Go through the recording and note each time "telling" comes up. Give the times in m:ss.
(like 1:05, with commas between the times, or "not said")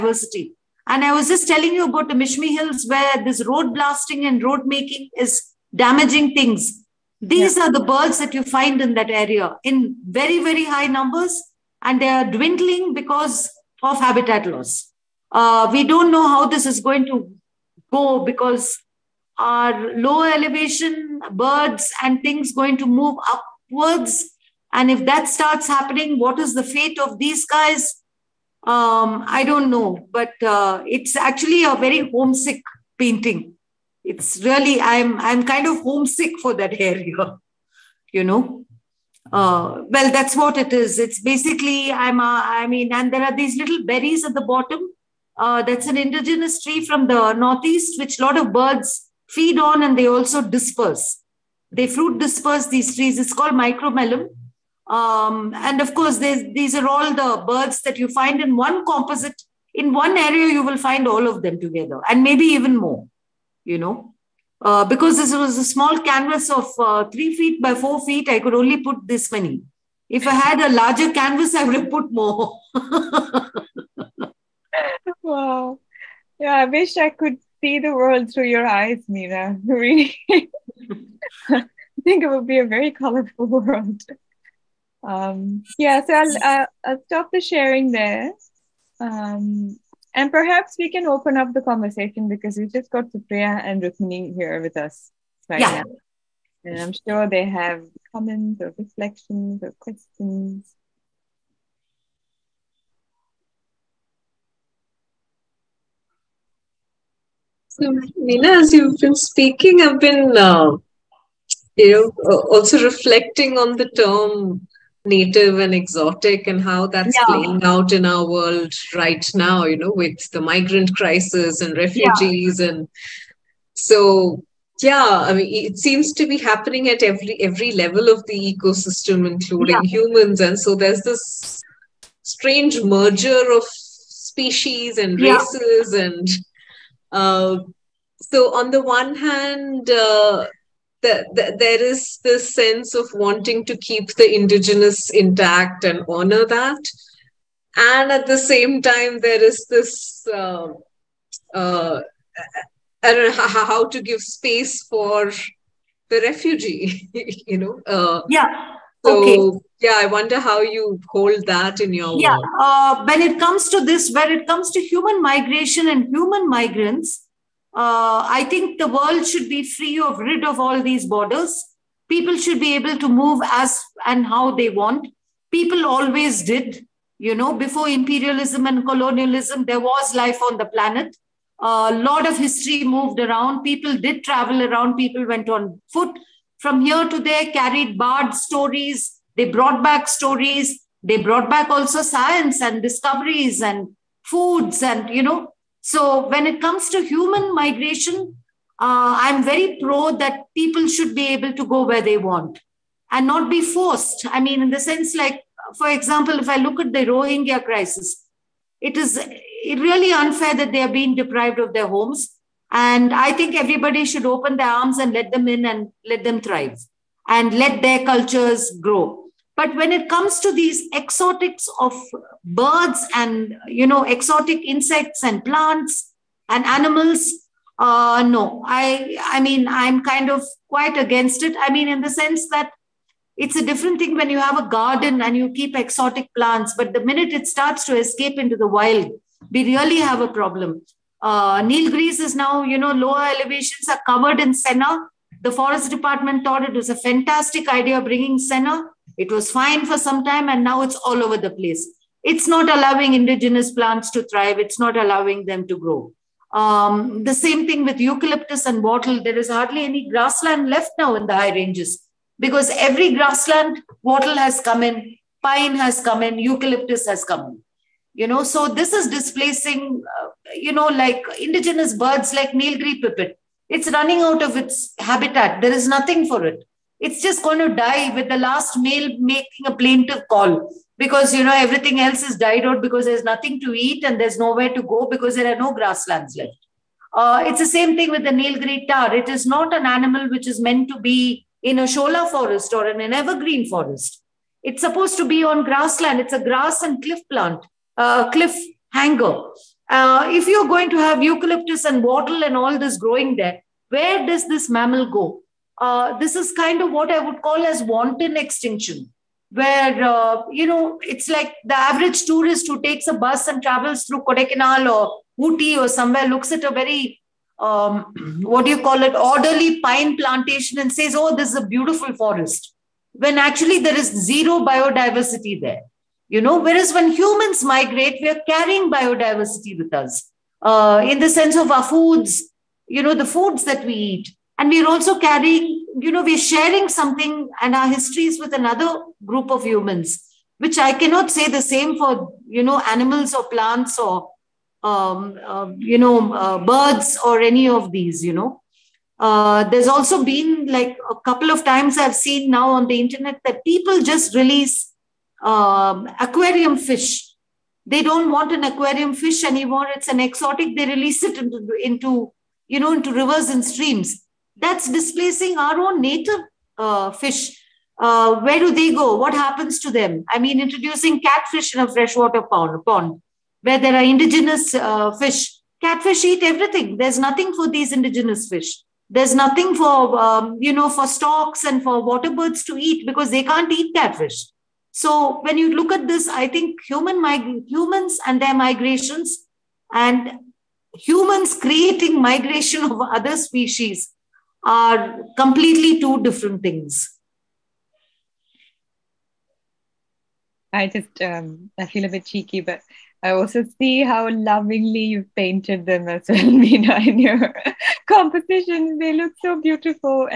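0:01.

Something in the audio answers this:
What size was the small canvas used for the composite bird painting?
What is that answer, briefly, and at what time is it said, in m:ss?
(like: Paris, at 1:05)
3 feet by 4 feet, at 1:07.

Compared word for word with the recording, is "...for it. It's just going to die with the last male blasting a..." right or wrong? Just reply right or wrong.
wrong.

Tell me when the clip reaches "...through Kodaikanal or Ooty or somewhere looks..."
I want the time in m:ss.
5:14.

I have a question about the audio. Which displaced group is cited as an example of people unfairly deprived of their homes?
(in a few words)
Rohingya.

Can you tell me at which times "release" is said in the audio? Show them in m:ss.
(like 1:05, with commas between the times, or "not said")
5:54, 6:00.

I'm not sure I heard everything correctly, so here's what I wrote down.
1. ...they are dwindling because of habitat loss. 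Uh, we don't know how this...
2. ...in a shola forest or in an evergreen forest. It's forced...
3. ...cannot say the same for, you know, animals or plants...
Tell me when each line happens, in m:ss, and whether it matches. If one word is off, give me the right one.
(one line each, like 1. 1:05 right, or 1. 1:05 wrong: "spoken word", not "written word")
1. 0:12 right
2. 4:51 wrong: "supposed", not "forced"
3. 5:40 right.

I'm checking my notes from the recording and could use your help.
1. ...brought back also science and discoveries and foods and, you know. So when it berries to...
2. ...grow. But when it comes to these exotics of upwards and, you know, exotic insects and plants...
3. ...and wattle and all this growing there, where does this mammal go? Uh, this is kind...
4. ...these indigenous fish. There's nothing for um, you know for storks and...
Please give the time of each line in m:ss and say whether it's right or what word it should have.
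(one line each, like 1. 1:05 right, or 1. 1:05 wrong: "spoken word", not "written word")
1. 3:11 wrong: "comes", not "berries"
2. 3:38 wrong: "birds", not "upwards"
3. 5:01 right
4. 6:17 right.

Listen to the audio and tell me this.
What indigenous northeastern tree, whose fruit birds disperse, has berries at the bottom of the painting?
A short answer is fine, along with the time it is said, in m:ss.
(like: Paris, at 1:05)
Micromelum, at 0:53.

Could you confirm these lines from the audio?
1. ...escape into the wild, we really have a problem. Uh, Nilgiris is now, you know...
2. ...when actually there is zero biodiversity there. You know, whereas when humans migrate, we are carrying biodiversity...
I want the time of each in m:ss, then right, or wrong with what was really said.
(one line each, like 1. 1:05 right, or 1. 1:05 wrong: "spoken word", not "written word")
1. 3:57 right
2. 5:23 right.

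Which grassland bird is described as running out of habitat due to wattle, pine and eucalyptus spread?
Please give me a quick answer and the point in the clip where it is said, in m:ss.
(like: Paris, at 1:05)
Nilgiri pipit, at 4:32.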